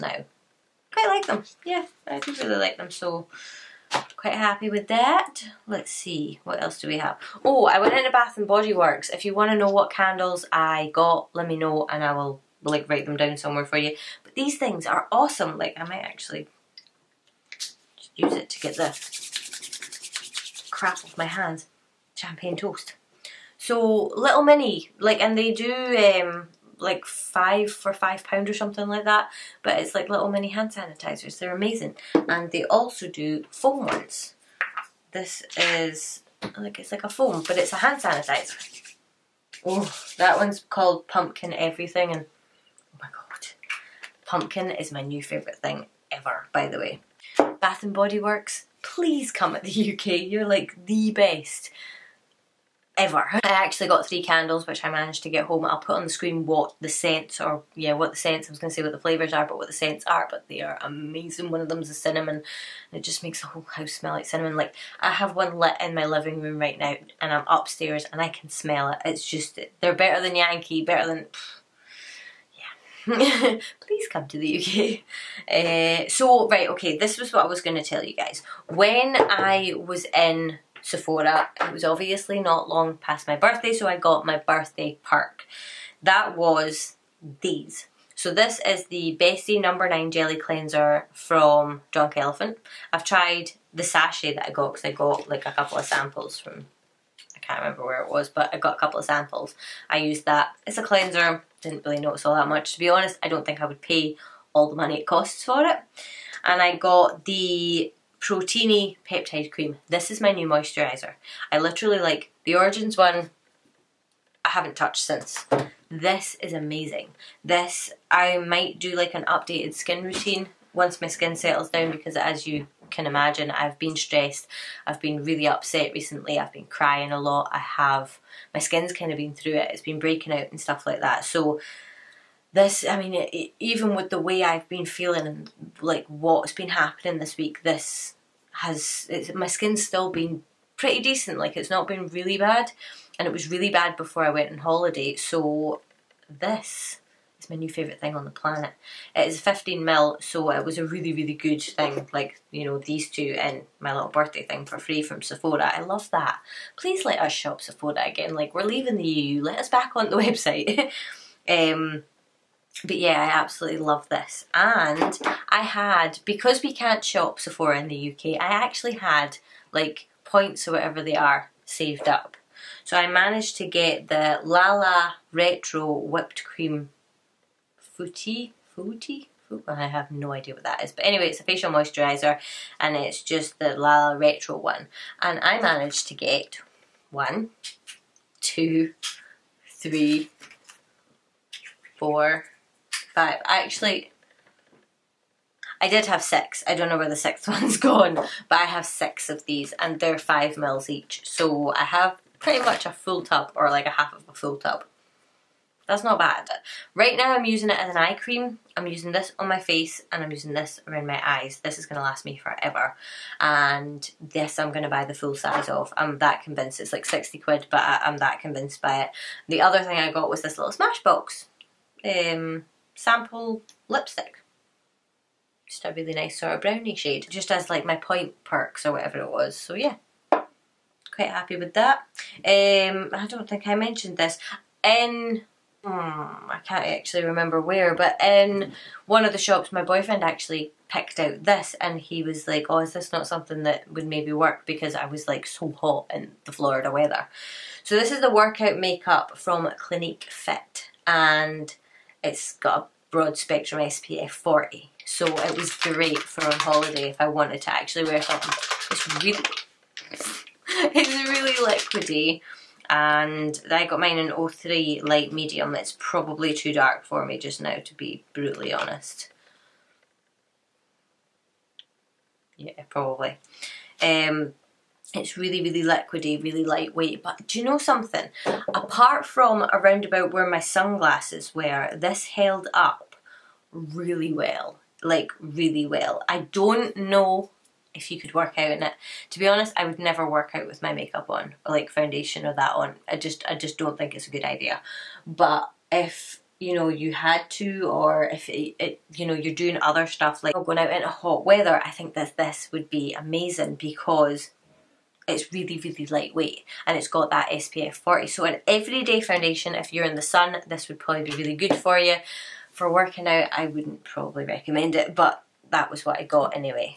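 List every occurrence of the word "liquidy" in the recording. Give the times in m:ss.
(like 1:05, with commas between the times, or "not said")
4:21, 4:35.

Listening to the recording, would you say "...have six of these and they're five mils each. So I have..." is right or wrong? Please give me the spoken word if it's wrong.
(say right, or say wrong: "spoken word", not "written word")
right.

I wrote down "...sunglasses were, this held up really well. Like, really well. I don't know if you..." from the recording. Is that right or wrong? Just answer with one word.
right.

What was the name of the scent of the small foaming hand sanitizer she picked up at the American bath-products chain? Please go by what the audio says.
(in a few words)
Pumpkin Everything.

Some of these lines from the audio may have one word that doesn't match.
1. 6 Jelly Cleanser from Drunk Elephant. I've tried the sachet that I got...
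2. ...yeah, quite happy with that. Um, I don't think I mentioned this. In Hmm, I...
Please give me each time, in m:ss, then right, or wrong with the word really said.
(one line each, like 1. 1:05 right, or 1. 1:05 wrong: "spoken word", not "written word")
1. 1:29 wrong: "9", not "6"
2. 3:49 right.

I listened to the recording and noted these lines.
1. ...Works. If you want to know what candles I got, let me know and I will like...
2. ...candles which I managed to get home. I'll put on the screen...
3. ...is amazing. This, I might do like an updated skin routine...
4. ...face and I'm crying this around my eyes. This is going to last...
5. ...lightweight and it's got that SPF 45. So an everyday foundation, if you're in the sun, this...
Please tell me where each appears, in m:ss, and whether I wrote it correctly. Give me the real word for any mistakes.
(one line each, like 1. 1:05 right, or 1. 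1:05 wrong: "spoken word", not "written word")
1. 0:08 right
2. 0:54 right
3. 1:56 right
4. 3:29 wrong: "using", not "crying"
5. 5:06 wrong: "40", not "45".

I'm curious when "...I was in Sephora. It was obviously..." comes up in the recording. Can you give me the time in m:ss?
1:19.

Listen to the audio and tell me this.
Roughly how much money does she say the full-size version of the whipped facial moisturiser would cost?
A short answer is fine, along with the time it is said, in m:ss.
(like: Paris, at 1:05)
60 quid, at 3:37.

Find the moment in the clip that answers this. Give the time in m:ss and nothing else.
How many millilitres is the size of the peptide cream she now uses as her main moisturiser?
2:29.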